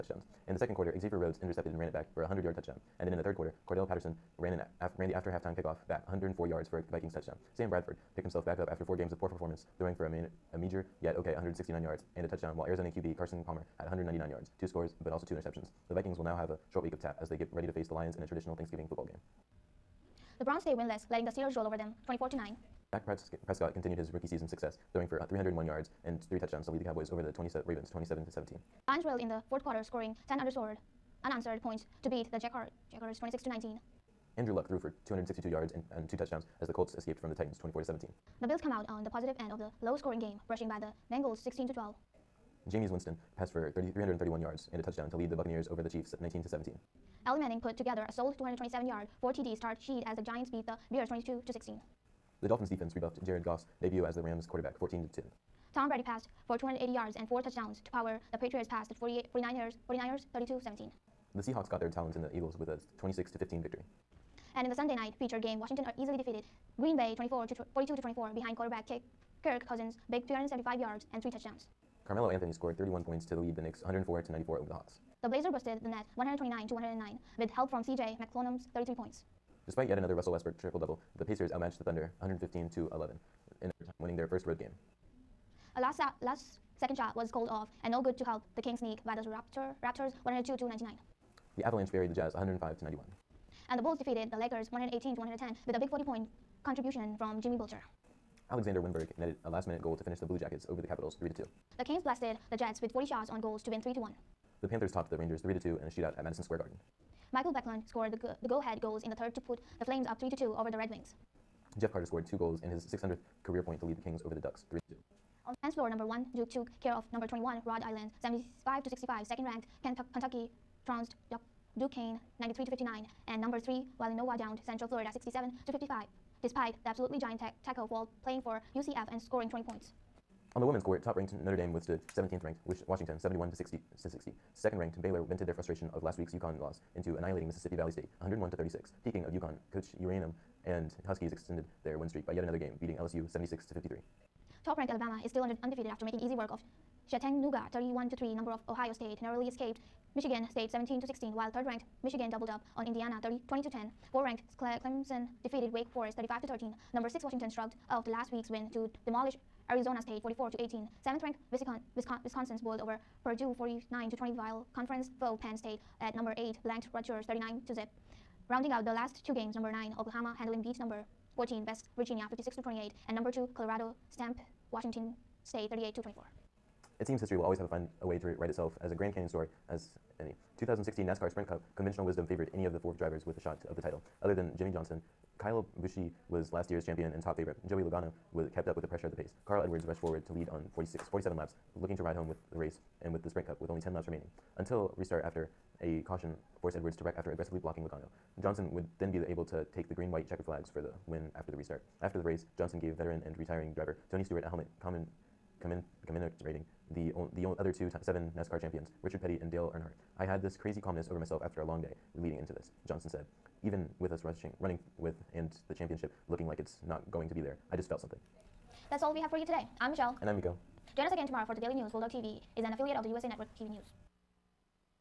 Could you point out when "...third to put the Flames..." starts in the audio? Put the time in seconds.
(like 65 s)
109 s.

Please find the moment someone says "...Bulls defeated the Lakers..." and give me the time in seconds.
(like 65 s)
93 s.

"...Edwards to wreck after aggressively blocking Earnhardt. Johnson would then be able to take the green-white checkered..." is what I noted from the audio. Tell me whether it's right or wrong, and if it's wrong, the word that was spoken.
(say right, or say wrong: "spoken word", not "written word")
wrong: "Logano", not "Earnhardt".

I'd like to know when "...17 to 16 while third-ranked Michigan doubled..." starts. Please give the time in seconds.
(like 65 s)
150 s.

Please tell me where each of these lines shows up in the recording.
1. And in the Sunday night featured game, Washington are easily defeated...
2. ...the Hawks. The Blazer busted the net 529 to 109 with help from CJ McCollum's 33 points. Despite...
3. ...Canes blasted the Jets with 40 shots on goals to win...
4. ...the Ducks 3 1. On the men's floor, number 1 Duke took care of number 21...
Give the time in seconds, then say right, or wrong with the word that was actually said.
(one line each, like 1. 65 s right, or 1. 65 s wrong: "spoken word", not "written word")
1. 64 s right
2. 74 s wrong: "129", not "529"
3. 101 s right
4. 114 s wrong: "2", not "1".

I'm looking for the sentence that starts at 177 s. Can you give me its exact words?
It seems history will always have a find a way to write itself as a Grand Canyon story as any.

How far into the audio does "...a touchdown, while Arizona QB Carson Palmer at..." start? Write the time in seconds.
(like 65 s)
12 s.